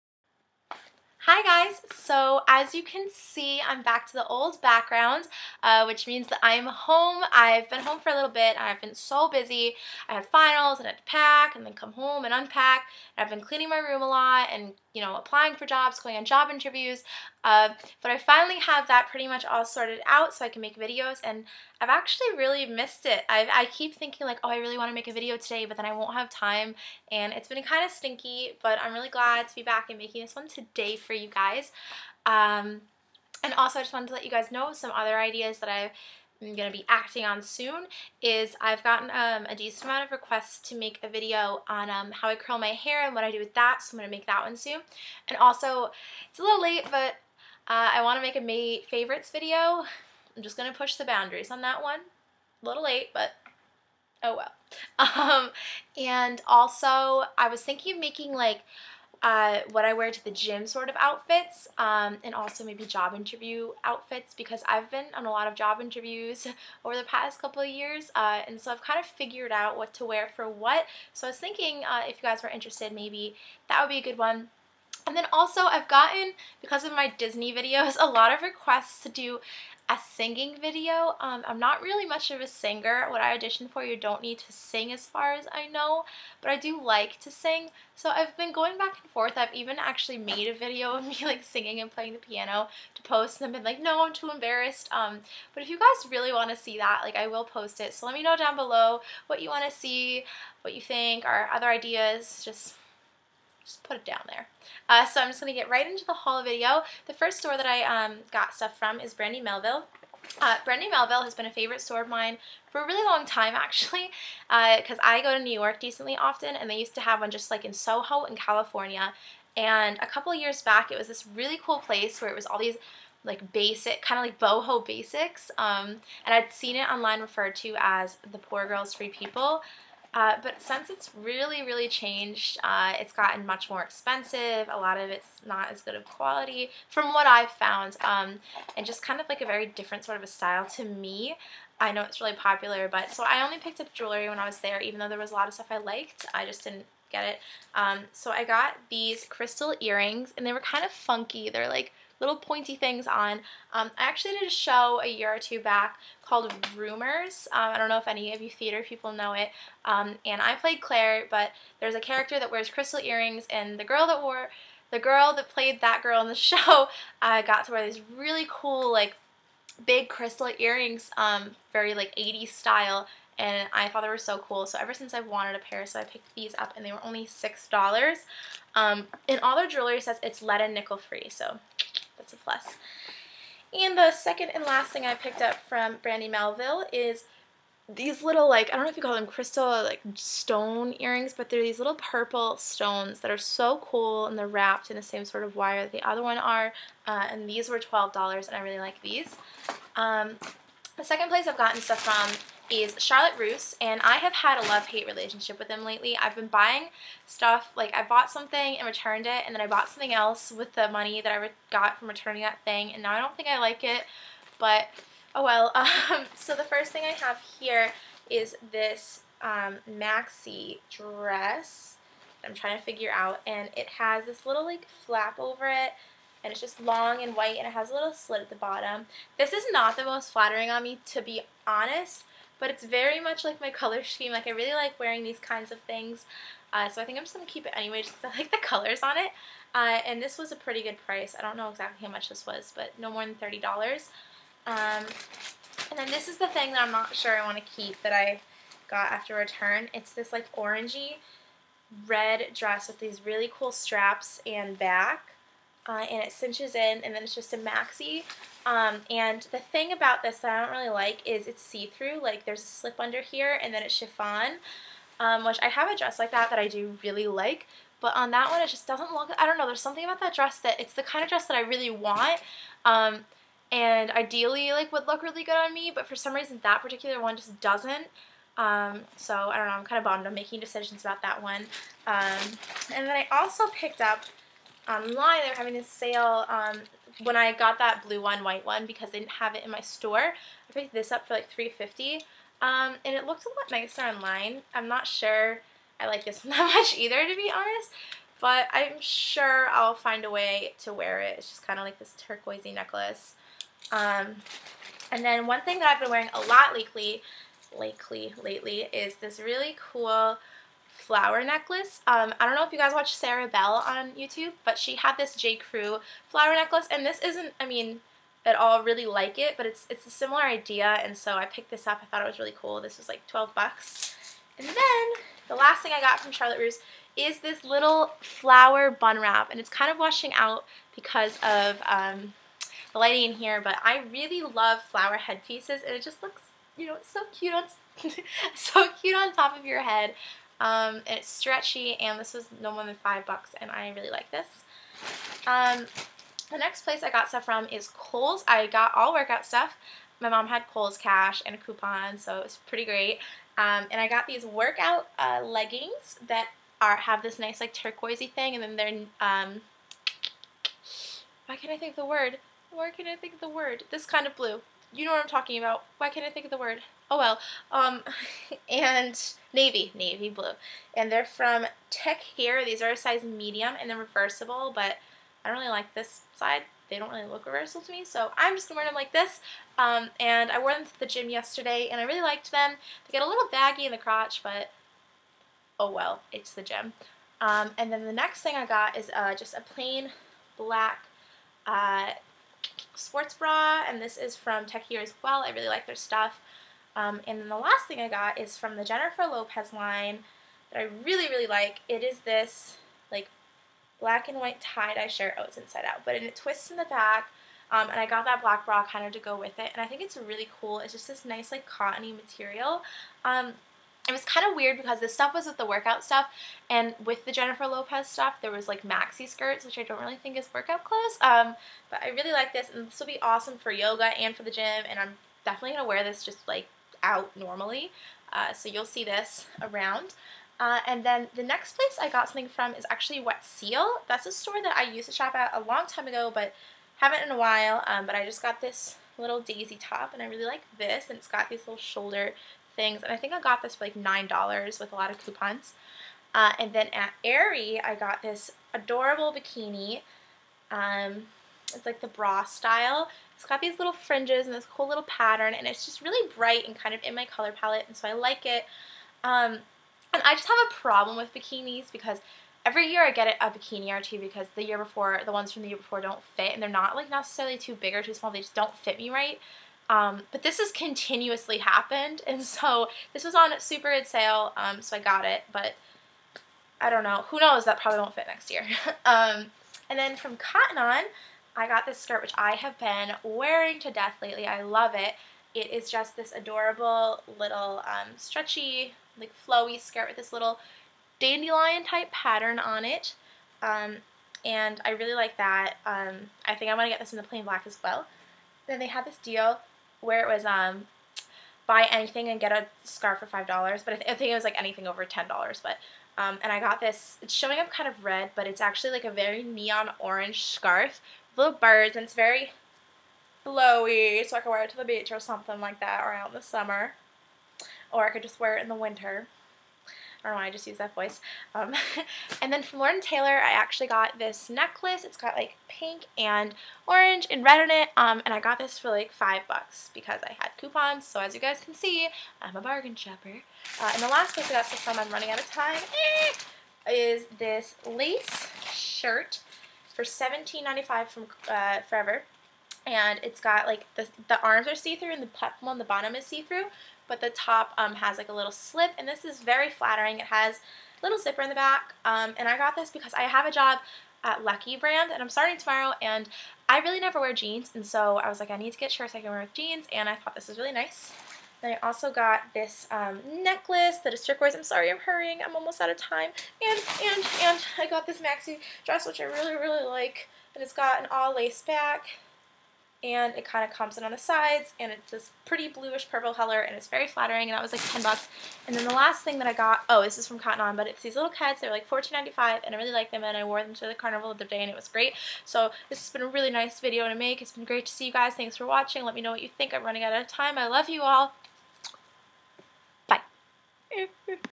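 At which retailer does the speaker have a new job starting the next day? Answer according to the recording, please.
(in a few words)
Lucky Brand.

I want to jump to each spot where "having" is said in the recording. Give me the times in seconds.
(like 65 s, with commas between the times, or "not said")
285 s.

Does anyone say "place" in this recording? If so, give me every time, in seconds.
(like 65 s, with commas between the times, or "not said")
121 s, 201 s, 346 s, 431 s, 534 s.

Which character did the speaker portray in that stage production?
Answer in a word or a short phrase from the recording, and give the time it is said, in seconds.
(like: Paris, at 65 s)
Claire, at 160 s.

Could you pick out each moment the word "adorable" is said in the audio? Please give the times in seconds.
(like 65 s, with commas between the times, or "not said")
448 s, 486 s.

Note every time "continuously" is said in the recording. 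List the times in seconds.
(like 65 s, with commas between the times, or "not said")
470 s.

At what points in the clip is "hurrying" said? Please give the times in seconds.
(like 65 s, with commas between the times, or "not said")
564 s.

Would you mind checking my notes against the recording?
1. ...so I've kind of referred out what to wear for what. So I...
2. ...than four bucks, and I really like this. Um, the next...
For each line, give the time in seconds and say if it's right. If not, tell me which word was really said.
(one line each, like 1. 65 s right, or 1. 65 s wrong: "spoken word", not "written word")
1. 68 s wrong: "figured", not "referred"
2. 342 s wrong: "five", not "four".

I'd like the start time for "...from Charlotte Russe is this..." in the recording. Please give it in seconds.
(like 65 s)
326 s.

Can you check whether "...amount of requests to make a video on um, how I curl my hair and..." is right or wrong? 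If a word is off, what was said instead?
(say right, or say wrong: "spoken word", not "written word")
right.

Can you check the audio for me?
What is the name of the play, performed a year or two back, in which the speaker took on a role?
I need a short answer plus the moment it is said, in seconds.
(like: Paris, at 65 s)
Rumors, at 156 s.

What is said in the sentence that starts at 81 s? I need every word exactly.
Um, I'm not really much of a singer.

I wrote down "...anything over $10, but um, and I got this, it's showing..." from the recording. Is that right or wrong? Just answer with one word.
right.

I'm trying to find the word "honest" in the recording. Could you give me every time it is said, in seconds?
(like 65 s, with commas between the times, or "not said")
231 s, 297 s.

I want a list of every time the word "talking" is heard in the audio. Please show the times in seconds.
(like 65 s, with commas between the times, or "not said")
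365 s.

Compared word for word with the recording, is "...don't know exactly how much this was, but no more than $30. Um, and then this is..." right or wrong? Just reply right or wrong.
right.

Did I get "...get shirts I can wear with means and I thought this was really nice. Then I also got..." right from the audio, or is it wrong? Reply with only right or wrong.
wrong.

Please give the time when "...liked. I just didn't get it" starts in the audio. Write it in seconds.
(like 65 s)
145 s.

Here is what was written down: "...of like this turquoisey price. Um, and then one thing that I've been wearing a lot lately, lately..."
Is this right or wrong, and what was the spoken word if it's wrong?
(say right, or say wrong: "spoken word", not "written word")
wrong: "necklace", not "price".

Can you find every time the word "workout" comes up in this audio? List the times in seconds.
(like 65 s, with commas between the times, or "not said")
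349 s, 354 s, 415 s, 420 s.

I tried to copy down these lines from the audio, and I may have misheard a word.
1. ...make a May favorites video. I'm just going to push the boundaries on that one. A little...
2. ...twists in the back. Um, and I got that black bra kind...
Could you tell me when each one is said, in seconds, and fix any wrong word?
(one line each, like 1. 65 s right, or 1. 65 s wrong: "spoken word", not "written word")
1. 48 s right
2. 406 s right.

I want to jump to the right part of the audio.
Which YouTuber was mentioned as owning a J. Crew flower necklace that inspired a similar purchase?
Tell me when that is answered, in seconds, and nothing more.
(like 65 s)
313 s.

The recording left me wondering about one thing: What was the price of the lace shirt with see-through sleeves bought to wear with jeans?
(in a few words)
$17.95.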